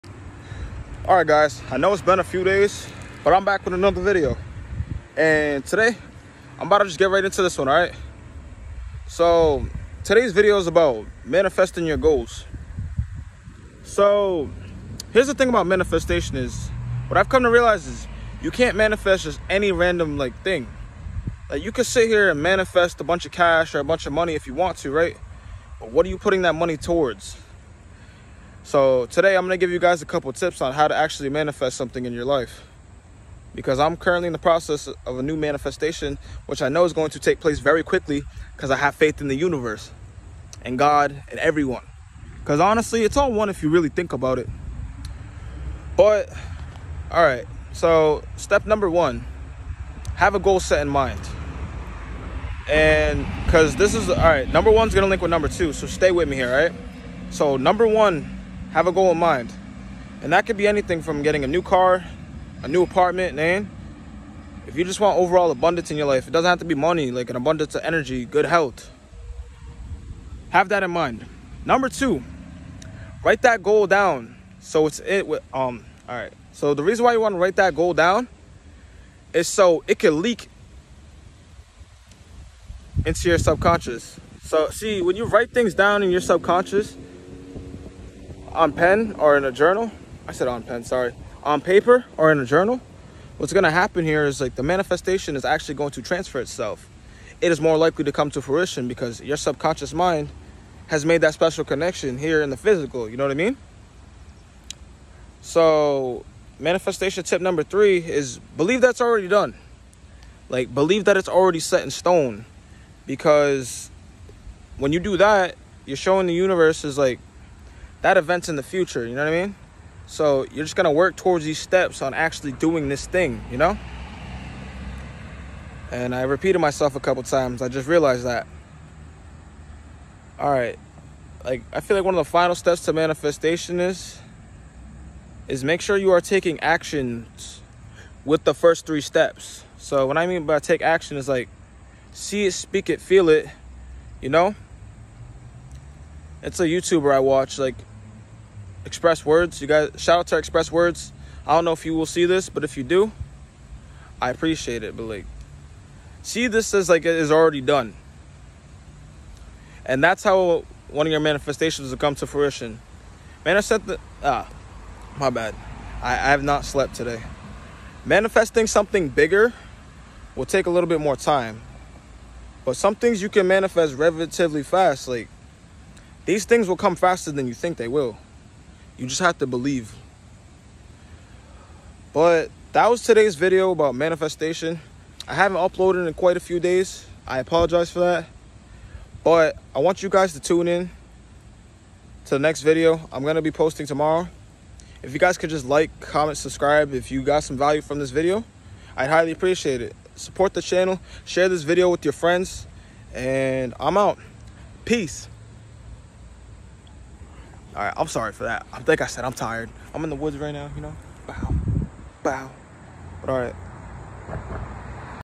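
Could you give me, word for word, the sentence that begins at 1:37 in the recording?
It is more likely to come to fruition because your subconscious mind has made that special connection here in the physical.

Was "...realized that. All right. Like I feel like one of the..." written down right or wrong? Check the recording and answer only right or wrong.
right.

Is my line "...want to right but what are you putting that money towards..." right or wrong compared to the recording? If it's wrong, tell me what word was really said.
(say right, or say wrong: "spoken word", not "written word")
right.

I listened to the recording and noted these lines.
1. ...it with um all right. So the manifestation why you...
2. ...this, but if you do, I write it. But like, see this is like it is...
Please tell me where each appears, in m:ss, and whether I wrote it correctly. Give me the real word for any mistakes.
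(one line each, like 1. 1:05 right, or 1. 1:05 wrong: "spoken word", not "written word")
1. 1:14 wrong: "reason", not "manifestation"
2. 2:32 wrong: "appreciate", not "write".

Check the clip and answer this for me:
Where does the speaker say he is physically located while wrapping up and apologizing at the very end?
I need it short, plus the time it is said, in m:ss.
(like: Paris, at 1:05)
in the woods, at 3:30.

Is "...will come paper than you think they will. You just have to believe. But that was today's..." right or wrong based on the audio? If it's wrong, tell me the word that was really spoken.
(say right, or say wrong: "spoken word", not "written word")
wrong: "faster", not "paper".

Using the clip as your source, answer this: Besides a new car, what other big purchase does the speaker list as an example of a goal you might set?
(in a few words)
a new apartment.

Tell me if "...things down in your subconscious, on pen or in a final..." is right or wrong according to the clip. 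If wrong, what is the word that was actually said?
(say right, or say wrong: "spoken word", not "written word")
wrong: "journal", not "final".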